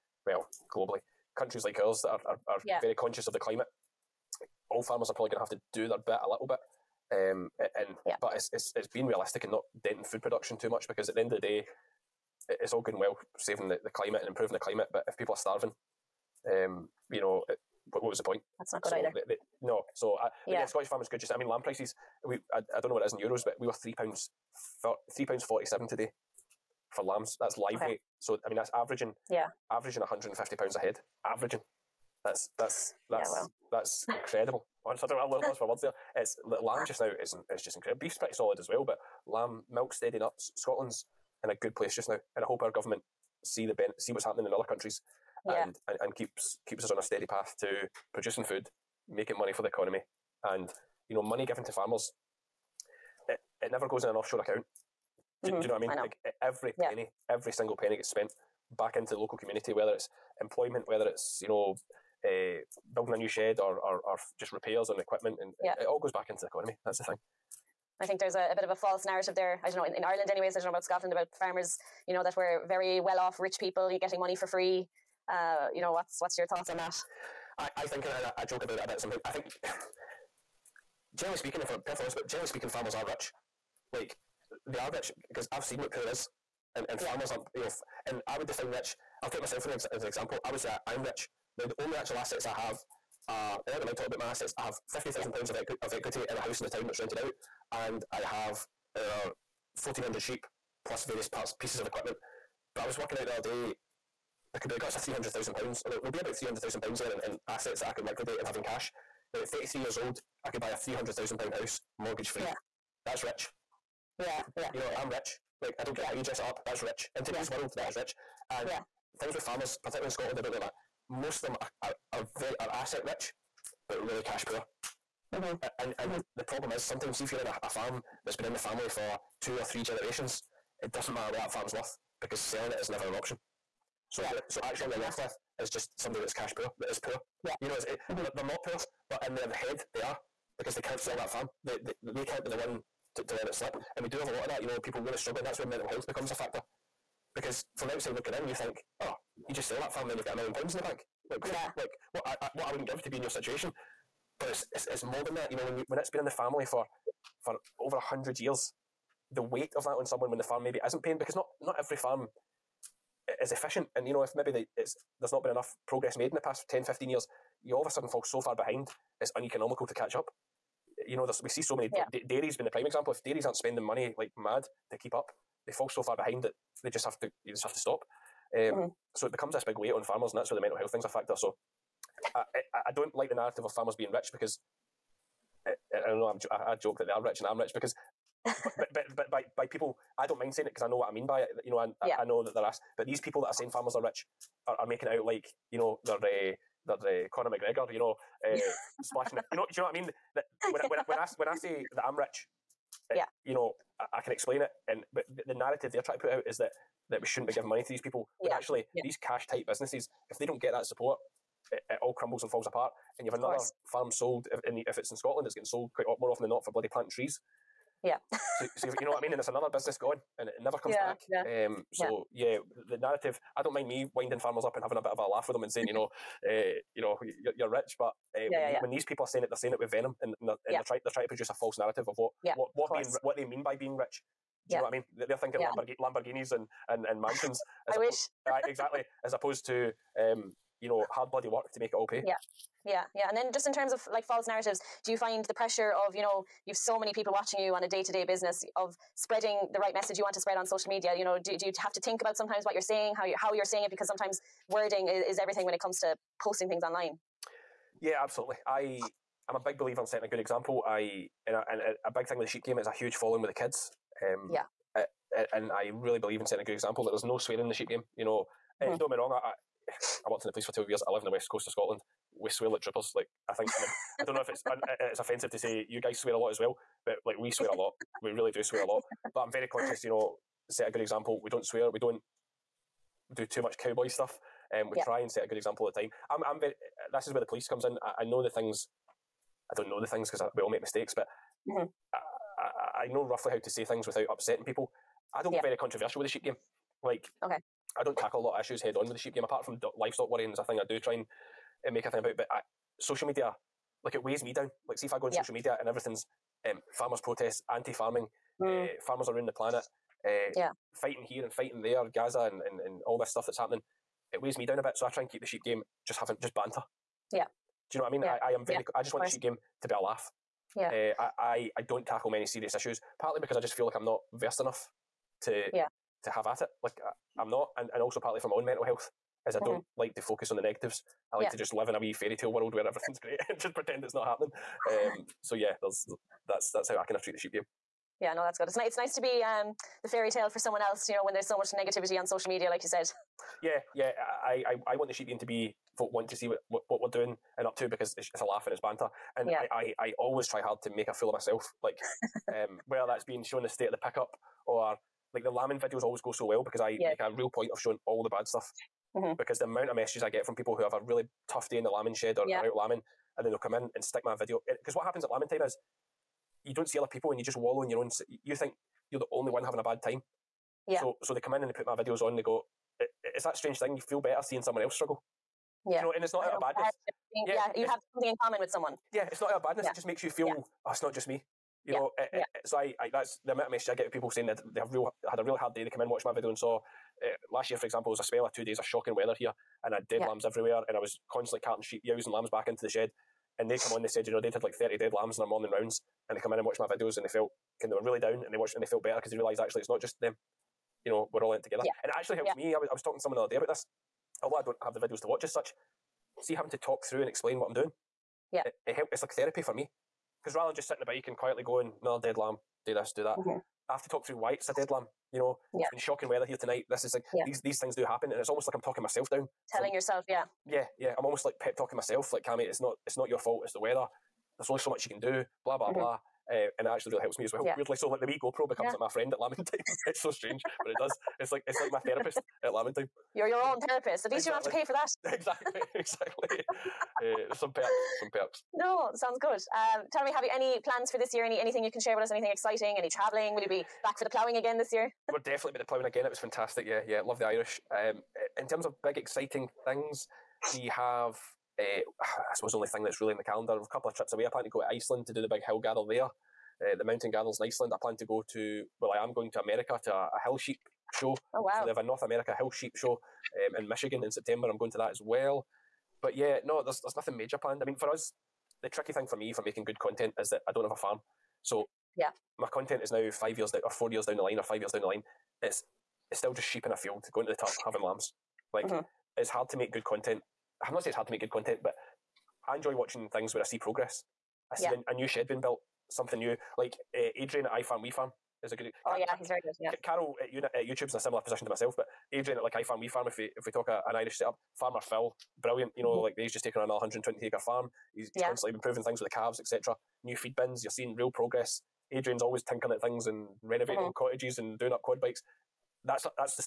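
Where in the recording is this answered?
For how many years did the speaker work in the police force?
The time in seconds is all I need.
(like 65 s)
270 s.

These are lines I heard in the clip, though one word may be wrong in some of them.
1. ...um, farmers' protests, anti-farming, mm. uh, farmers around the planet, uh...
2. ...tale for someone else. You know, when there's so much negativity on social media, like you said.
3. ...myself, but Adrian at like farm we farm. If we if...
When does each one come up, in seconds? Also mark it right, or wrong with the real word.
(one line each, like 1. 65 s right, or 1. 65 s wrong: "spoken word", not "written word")
1. 306 s right
2. 340 s right
3. 491 s right.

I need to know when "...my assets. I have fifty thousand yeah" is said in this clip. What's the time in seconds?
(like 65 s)
94 s.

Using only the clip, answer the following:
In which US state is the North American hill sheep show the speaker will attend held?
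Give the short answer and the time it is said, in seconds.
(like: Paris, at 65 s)
Michigan, at 463 s.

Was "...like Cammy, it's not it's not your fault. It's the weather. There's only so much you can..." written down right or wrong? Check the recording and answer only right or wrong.
right.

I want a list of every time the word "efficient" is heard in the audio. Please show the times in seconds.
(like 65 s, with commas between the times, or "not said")
163 s.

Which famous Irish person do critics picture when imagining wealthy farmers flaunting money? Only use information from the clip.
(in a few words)
Conor McGregor.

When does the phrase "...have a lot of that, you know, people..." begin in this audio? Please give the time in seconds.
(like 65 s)
144 s.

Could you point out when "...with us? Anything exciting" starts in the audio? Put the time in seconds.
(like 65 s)
442 s.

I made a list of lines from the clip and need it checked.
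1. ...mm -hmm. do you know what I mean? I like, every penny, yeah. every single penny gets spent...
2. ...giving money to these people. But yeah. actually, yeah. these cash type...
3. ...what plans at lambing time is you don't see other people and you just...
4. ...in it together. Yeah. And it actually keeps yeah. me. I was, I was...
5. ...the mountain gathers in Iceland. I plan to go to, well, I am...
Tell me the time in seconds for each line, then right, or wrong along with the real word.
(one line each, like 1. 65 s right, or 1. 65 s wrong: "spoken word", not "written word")
1. 55 s right
2. 207 s right
3. 364 s wrong: "happens", not "plans"
4. 401 s wrong: "helps", not "keeps"
5. 456 s right.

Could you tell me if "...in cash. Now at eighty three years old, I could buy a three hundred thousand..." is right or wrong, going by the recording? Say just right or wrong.
wrong.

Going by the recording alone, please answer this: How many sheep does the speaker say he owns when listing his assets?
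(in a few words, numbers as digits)
1,400.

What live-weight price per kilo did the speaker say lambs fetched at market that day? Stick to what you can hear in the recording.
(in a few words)
£3.47.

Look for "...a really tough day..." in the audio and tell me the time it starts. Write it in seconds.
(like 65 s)
360 s.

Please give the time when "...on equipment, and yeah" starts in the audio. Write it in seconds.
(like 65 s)
64 s.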